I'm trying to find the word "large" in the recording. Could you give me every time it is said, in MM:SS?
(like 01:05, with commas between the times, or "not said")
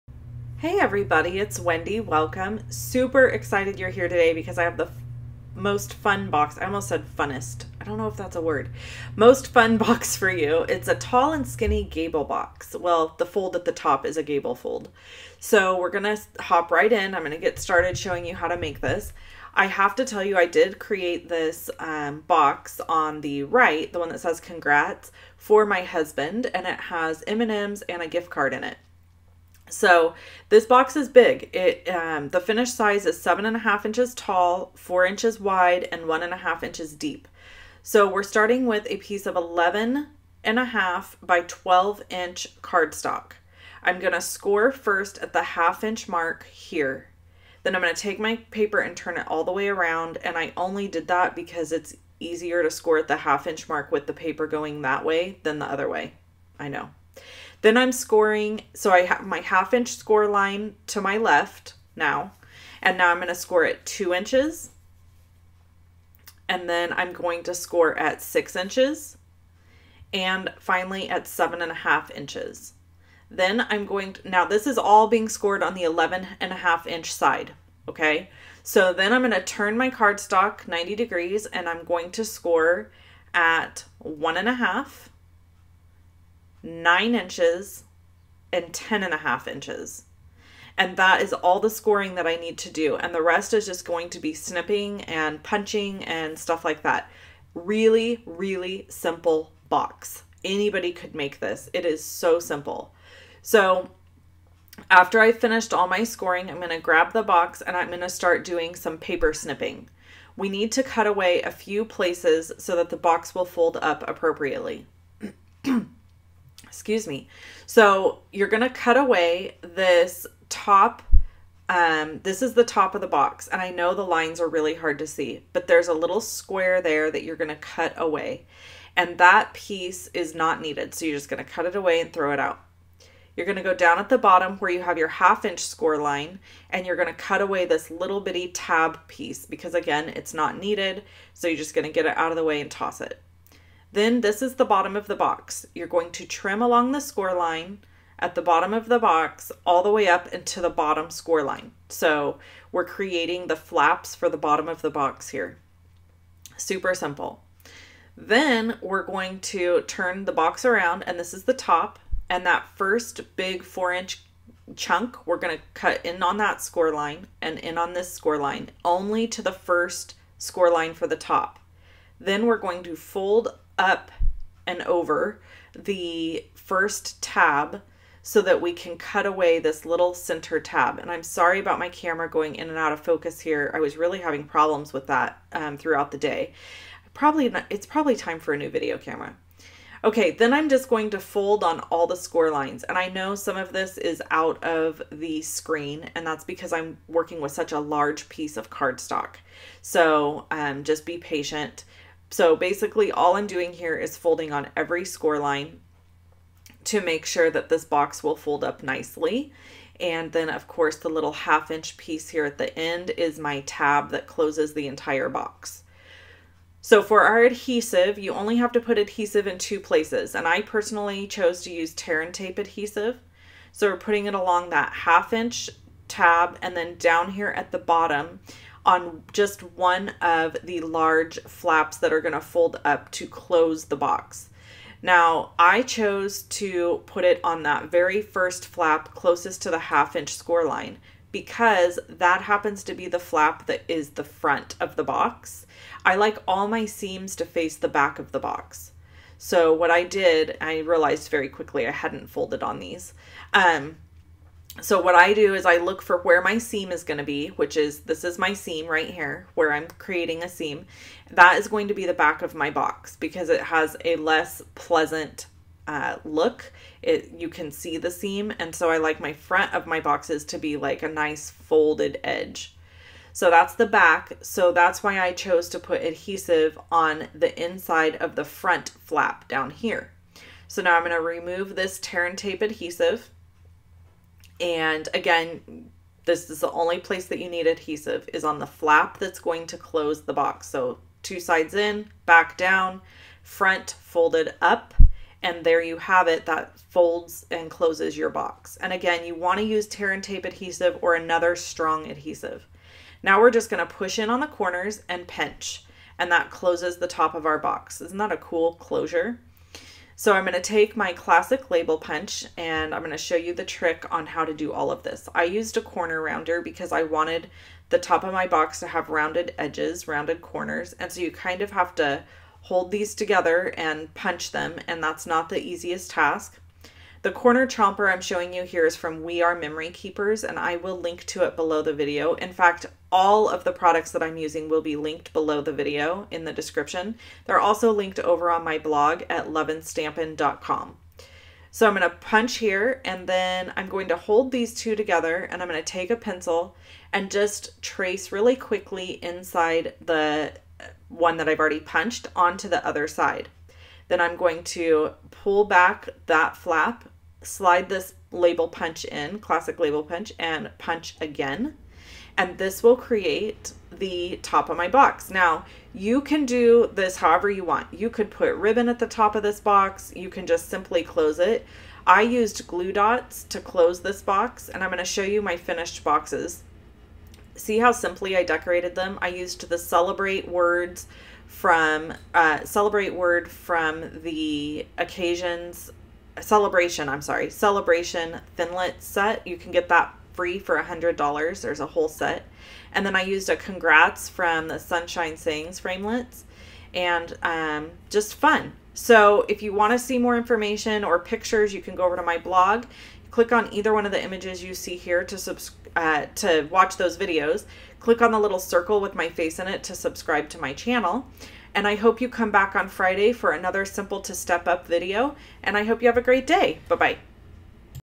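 03:17, 03:50.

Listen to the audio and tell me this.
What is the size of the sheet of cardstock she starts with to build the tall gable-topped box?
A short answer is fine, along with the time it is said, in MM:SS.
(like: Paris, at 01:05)
11 1/2 by 12 inch, at 00:39.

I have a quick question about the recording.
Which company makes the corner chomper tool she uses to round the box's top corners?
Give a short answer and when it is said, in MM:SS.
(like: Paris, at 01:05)
We Are Memory Keepers, at 05:29.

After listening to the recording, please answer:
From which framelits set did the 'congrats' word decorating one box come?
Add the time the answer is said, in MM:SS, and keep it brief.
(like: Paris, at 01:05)
Sunshine Sayings, at 06:34.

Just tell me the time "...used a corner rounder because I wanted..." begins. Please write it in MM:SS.
05:15.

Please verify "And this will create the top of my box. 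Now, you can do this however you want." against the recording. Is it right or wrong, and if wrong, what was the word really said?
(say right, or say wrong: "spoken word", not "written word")
right.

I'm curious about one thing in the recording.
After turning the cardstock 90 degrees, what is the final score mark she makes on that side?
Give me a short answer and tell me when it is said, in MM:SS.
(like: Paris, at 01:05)
10 1/2 inches, at 01:28.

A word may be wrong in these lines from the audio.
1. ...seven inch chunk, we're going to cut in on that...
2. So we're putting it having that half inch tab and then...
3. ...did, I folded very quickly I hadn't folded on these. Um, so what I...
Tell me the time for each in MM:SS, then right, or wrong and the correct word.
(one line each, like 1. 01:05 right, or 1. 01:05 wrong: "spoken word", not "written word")
1. 02:43 wrong: "four", not "seven"
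2. 03:43 wrong: "along", not "having"
3. 04:10 wrong: "realized", not "folded".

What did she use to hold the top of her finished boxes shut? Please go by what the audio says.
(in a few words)
Glue dots.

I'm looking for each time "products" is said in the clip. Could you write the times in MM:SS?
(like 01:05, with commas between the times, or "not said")
05:33.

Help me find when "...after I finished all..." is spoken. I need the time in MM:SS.
01:44.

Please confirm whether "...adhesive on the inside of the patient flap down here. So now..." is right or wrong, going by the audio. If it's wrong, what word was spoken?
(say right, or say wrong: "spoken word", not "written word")
wrong: "front", not "patient".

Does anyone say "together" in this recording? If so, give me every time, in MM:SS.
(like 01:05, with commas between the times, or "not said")
05:23, 05:44.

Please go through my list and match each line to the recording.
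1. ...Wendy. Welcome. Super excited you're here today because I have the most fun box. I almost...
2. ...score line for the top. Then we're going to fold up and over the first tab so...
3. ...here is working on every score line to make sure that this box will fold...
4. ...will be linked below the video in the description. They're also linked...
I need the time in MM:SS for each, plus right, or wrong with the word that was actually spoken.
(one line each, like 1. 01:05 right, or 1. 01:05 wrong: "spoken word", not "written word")
1. 00:01 right
2. 02:50 right
3. 03:23 wrong: "folding", not "working"
4. 05:34 right.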